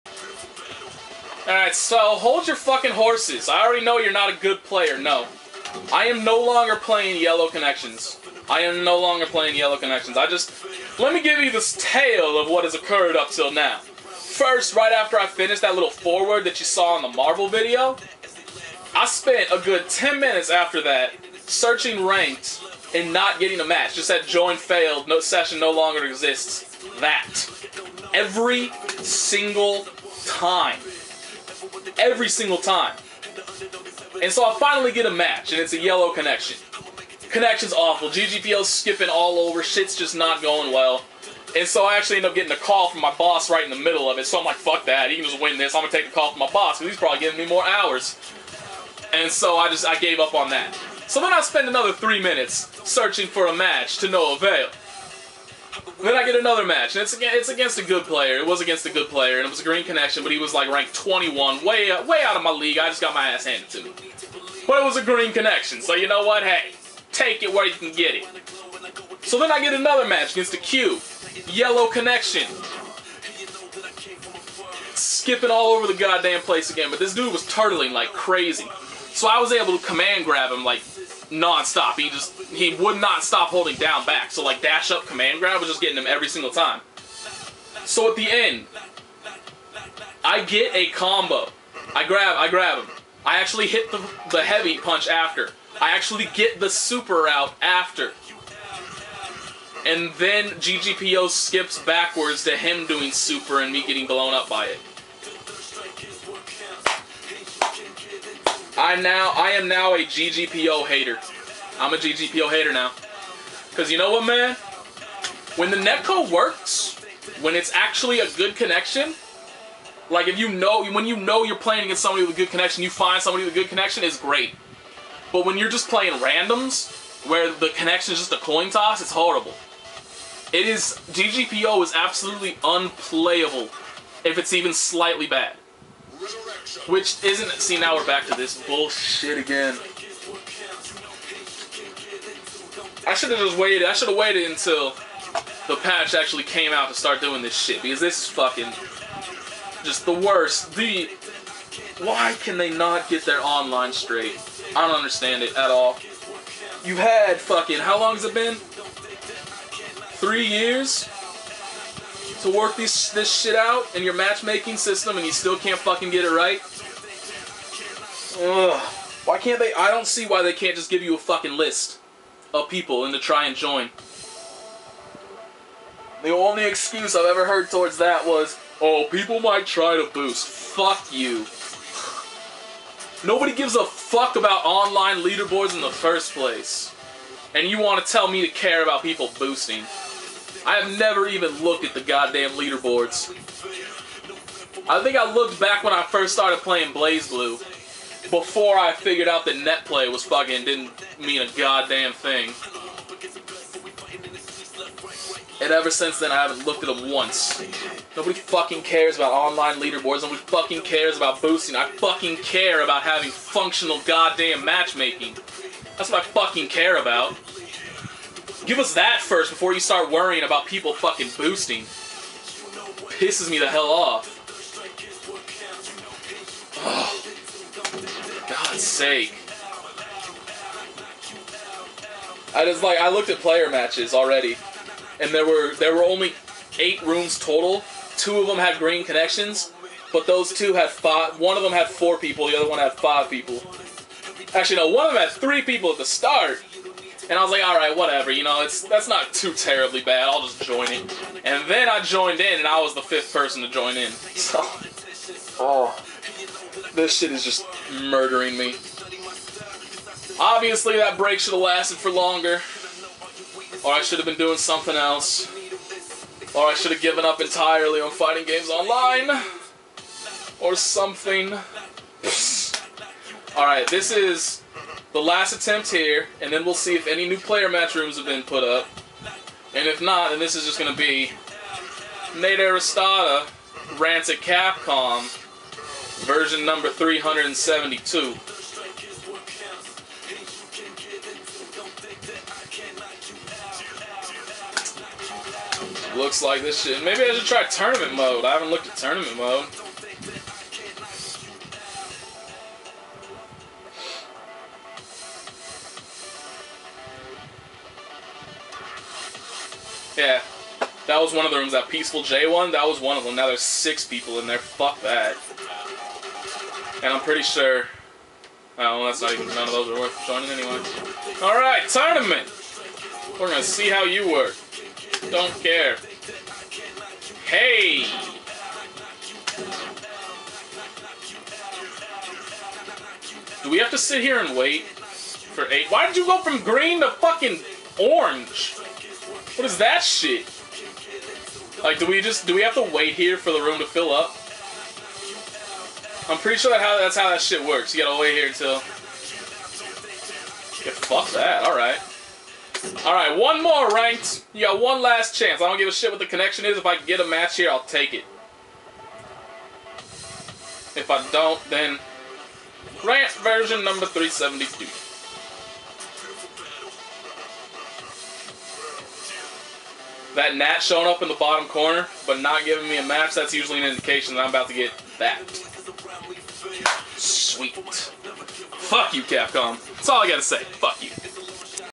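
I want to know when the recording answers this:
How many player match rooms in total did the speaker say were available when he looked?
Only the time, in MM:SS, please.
03:56.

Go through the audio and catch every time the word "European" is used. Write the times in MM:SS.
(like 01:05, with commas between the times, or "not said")
not said.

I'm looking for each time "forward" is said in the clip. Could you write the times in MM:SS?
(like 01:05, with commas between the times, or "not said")
00:15.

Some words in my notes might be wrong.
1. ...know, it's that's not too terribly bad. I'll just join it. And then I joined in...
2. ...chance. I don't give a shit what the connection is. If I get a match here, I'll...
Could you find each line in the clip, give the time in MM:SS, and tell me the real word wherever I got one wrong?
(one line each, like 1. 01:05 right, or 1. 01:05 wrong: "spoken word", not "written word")
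1. 04:08 right
2. 05:55 right.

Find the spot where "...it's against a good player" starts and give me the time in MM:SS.
00:57.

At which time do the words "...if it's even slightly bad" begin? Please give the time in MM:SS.
02:14.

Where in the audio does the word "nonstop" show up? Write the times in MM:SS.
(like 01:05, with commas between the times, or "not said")
01:21.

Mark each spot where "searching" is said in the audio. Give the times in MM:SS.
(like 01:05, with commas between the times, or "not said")
00:21, 00:52.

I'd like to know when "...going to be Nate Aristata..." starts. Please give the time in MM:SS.
04:40.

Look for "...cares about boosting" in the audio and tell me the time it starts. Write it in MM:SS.
03:30.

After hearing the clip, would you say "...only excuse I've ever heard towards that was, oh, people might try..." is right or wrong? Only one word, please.
right.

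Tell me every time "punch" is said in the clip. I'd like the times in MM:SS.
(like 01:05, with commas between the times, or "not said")
01:34.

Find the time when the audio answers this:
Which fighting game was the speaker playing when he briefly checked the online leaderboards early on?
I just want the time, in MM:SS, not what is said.
03:16.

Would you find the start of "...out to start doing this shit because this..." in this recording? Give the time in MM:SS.
02:26.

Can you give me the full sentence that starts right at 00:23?
Just that join failed, no session no longer exists.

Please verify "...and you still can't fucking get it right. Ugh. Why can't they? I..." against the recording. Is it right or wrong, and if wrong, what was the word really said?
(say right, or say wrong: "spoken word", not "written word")
right.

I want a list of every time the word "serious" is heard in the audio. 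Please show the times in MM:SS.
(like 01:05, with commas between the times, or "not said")
not said.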